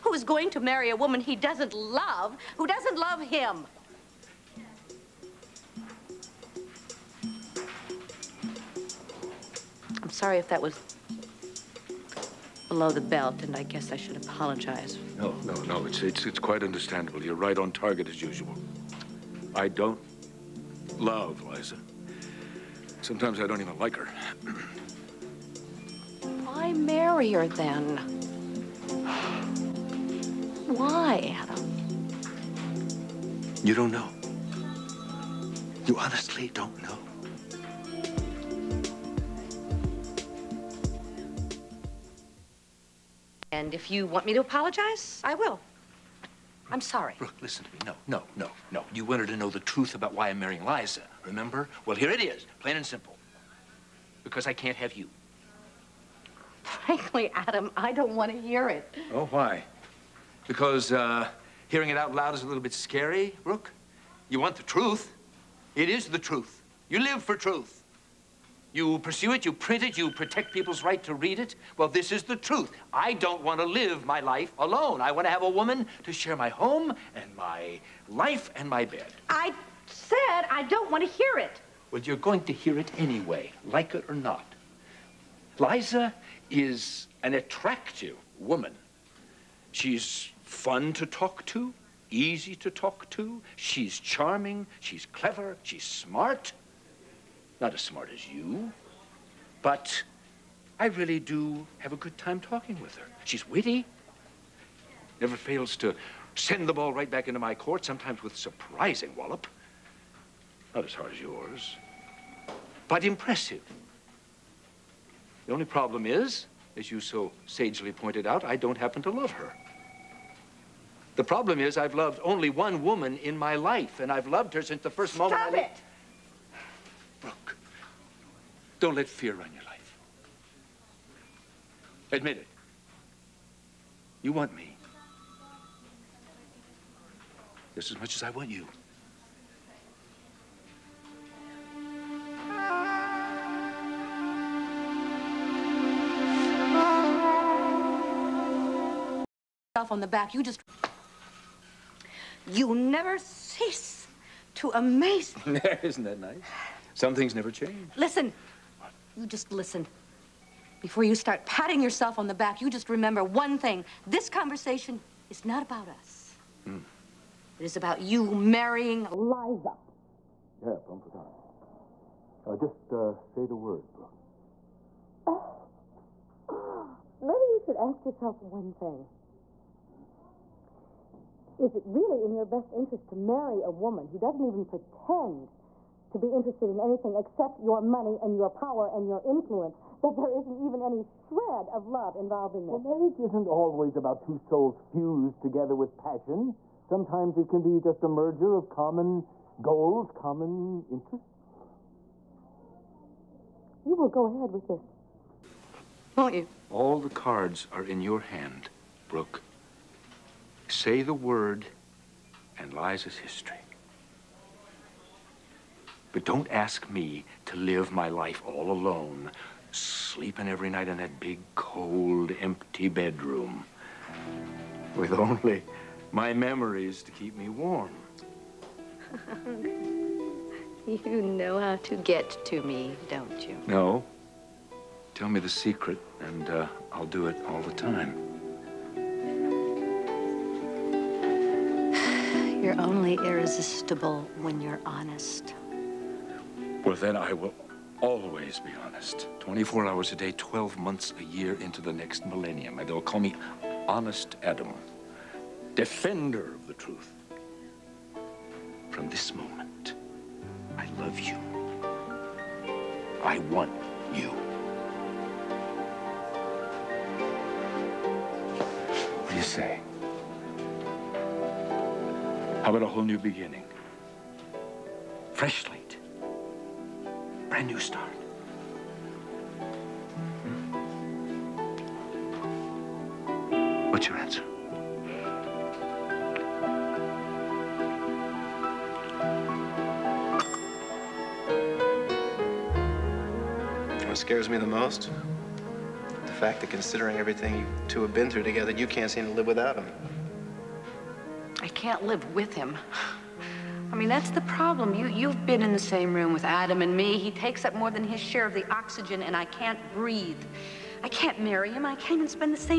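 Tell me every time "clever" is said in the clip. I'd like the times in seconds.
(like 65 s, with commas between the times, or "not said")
95 s.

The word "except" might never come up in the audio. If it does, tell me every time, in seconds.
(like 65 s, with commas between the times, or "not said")
187 s.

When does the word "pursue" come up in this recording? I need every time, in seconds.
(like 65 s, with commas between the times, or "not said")
68 s.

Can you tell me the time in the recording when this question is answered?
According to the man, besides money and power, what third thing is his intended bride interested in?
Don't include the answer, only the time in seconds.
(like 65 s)
189 s.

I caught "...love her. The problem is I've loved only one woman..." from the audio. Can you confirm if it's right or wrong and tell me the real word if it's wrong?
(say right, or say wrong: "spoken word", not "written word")
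right.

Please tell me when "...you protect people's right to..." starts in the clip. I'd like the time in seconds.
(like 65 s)
69 s.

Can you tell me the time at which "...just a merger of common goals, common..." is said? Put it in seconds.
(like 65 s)
197 s.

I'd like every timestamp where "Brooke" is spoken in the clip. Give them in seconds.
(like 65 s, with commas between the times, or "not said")
47 s, 63 s, 127 s, 173 s, 209 s.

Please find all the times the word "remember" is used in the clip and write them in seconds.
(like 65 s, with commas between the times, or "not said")
51 s, 162 s.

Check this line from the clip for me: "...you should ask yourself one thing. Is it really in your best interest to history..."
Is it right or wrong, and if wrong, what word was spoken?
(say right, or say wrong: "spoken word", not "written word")
wrong: "marry", not "history".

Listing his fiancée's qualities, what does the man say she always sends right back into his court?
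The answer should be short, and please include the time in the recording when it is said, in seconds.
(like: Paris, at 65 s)
the ball, at 106 s.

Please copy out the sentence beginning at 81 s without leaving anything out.
Well, you're going to hear it anyway, like it or not.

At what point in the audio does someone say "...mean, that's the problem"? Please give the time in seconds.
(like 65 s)
303 s.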